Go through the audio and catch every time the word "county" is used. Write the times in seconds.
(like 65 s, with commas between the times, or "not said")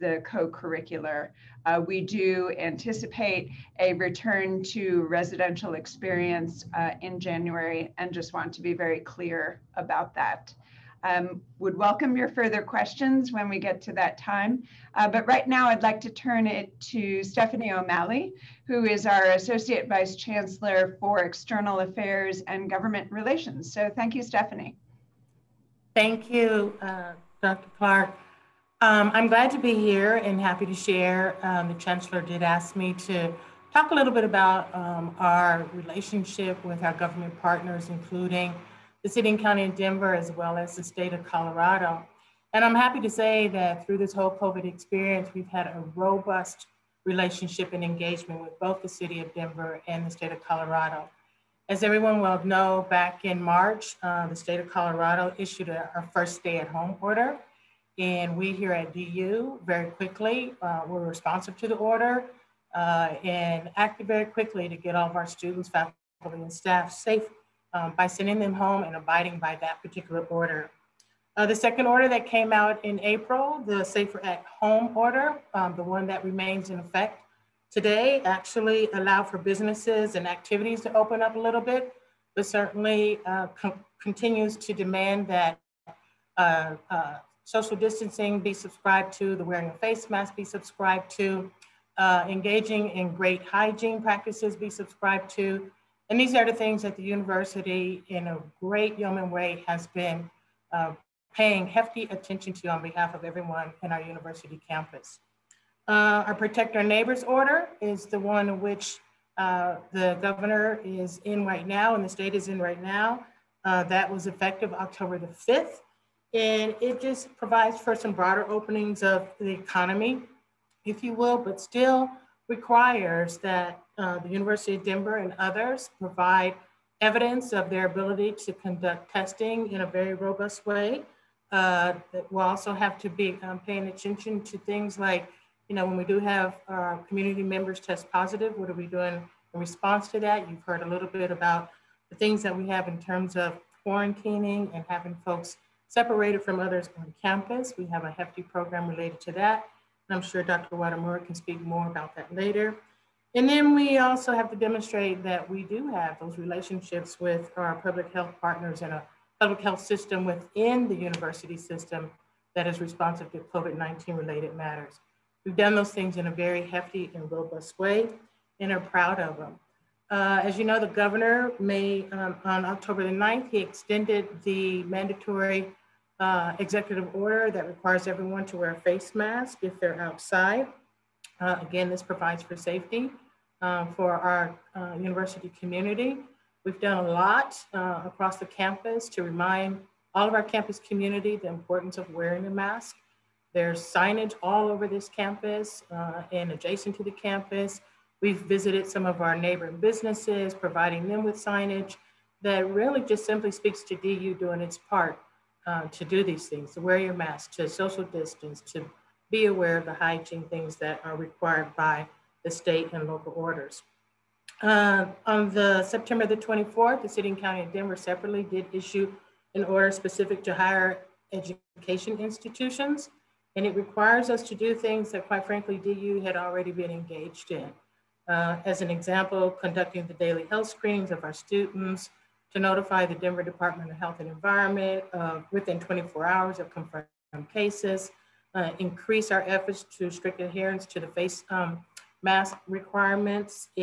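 39 s, 217 s.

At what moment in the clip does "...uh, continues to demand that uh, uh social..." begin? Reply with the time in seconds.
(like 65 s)
83 s.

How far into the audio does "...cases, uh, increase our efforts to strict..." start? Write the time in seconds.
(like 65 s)
237 s.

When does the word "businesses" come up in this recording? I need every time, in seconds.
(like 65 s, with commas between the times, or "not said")
79 s, 199 s.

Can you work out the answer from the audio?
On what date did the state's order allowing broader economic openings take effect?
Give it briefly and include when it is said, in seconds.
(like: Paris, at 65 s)
October 5, at 114 s.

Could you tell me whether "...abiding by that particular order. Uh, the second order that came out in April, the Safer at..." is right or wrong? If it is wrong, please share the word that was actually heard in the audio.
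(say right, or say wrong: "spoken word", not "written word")
right.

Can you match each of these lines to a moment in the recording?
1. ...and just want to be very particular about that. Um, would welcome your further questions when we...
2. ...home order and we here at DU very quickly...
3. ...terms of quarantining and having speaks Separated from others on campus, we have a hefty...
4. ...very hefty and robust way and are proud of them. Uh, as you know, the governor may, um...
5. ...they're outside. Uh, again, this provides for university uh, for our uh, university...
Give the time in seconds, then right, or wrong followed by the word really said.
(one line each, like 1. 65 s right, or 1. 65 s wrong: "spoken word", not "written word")
1. 7 s wrong: "clear", not "particular"
2. 56 s right
3. 142 s wrong: "folks", not "speaks"
4. 166 s right
5. 179 s wrong: "safety", not "university".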